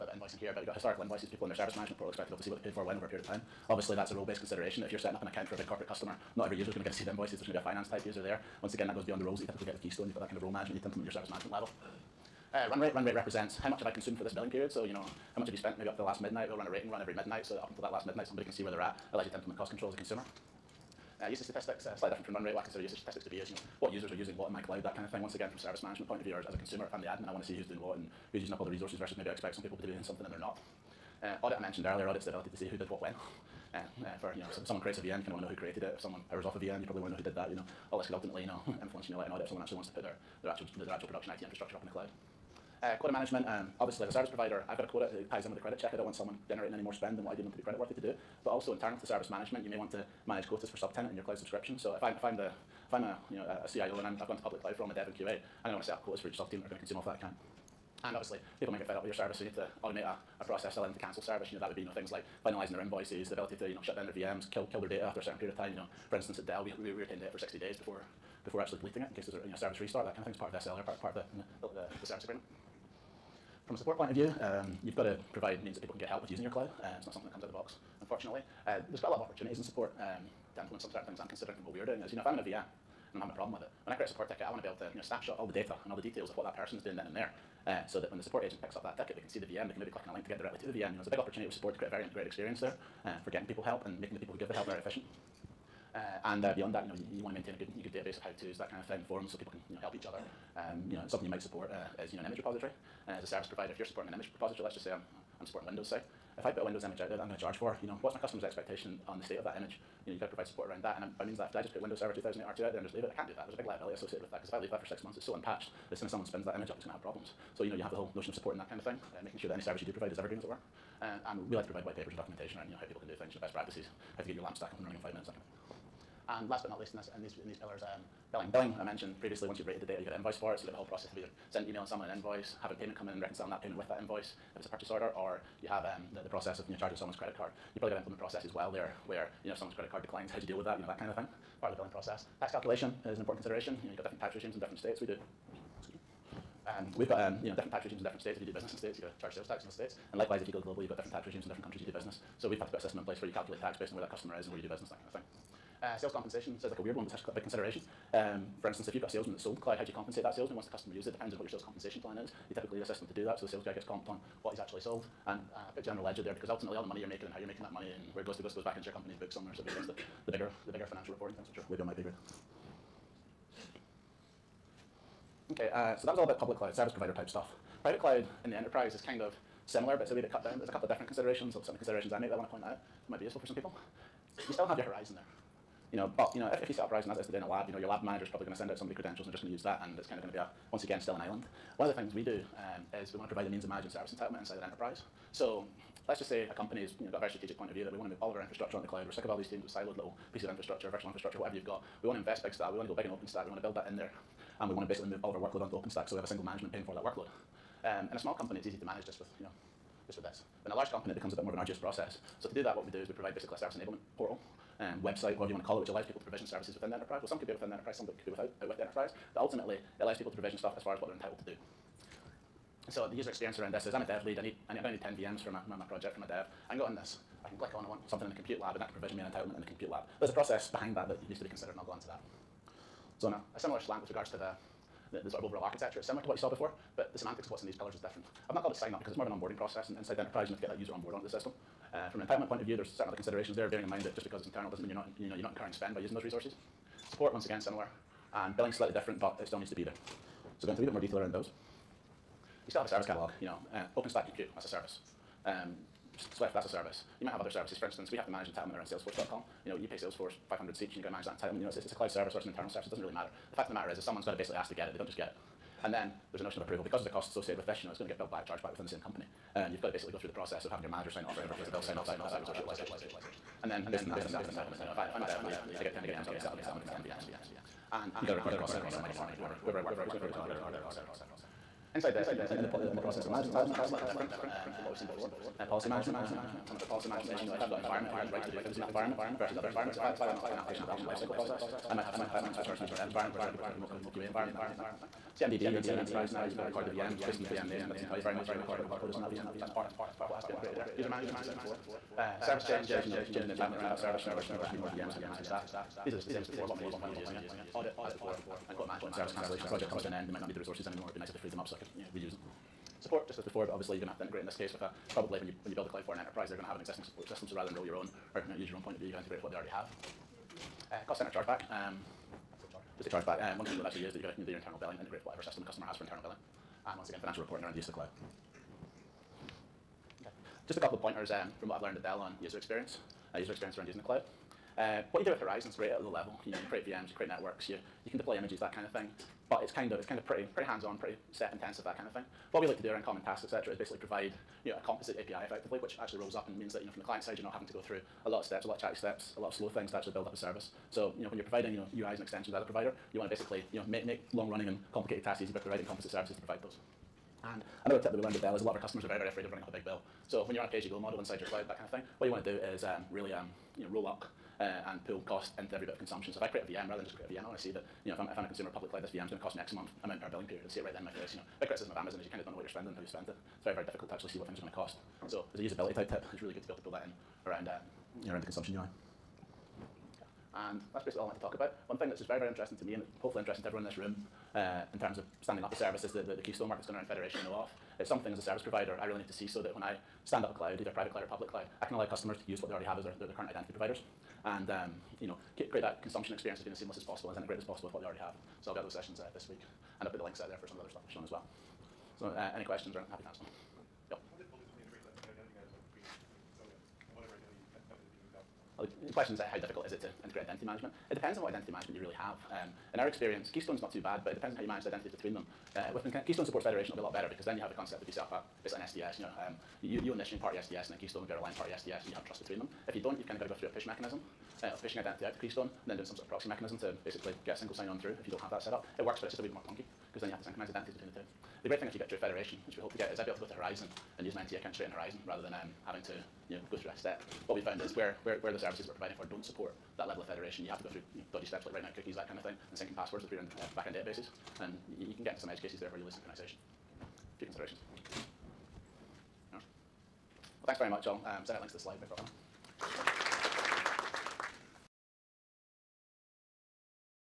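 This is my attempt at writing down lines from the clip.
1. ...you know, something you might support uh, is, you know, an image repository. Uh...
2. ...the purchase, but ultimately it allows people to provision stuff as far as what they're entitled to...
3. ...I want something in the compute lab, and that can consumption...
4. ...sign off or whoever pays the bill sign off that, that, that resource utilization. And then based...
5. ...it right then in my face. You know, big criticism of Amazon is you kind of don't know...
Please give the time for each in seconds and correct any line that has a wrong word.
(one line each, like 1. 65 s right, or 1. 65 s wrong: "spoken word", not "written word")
1. 100 s right
2. 218 s wrong: "enterprise", not "purchase"
3. 227 s wrong: "provision", not "consumption"
4. 271 s right
5. 370 s right.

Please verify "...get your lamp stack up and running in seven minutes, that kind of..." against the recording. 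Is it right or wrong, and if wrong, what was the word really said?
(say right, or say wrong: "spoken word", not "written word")
wrong: "five", not "seven".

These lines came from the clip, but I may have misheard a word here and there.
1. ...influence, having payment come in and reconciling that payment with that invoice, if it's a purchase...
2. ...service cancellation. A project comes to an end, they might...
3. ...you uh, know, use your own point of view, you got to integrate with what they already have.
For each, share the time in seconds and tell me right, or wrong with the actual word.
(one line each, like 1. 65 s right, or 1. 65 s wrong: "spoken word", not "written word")
1. 132 s wrong: "invoice", not "influence"
2. 309 s right
3. 318 s right.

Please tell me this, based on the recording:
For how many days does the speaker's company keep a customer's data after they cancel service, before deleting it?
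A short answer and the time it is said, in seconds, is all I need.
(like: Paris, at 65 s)
60 days, at 67 s.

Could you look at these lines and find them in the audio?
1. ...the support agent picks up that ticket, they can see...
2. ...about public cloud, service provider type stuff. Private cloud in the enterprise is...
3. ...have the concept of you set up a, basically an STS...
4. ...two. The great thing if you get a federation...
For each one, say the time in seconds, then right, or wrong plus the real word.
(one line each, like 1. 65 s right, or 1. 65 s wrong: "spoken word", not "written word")
1. 88 s right
2. 176 s right
3. 417 s right
4. 431 s right.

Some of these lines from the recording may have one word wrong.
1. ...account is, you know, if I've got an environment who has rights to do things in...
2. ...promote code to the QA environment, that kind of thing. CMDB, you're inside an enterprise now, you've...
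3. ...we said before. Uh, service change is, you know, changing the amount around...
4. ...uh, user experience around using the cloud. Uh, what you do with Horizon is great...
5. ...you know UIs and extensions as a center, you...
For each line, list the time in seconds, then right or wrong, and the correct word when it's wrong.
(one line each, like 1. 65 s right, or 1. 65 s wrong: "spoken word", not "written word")
1. 287 s wrong: "management", not "account"
2. 293 s right
3. 301 s wrong: "entitlement", not "amount"
4. 333 s right
5. 351 s wrong: "provider", not "center".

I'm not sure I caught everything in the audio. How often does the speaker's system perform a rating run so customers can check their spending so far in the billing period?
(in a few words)
Every midnight.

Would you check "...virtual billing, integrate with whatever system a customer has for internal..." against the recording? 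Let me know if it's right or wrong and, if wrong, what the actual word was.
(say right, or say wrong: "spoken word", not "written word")
wrong: "internal", not "virtual".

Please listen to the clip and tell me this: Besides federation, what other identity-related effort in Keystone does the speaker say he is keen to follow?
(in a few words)
OAuth.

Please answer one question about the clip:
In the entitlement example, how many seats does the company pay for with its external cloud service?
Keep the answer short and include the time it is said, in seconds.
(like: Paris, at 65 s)
500, at 260 s.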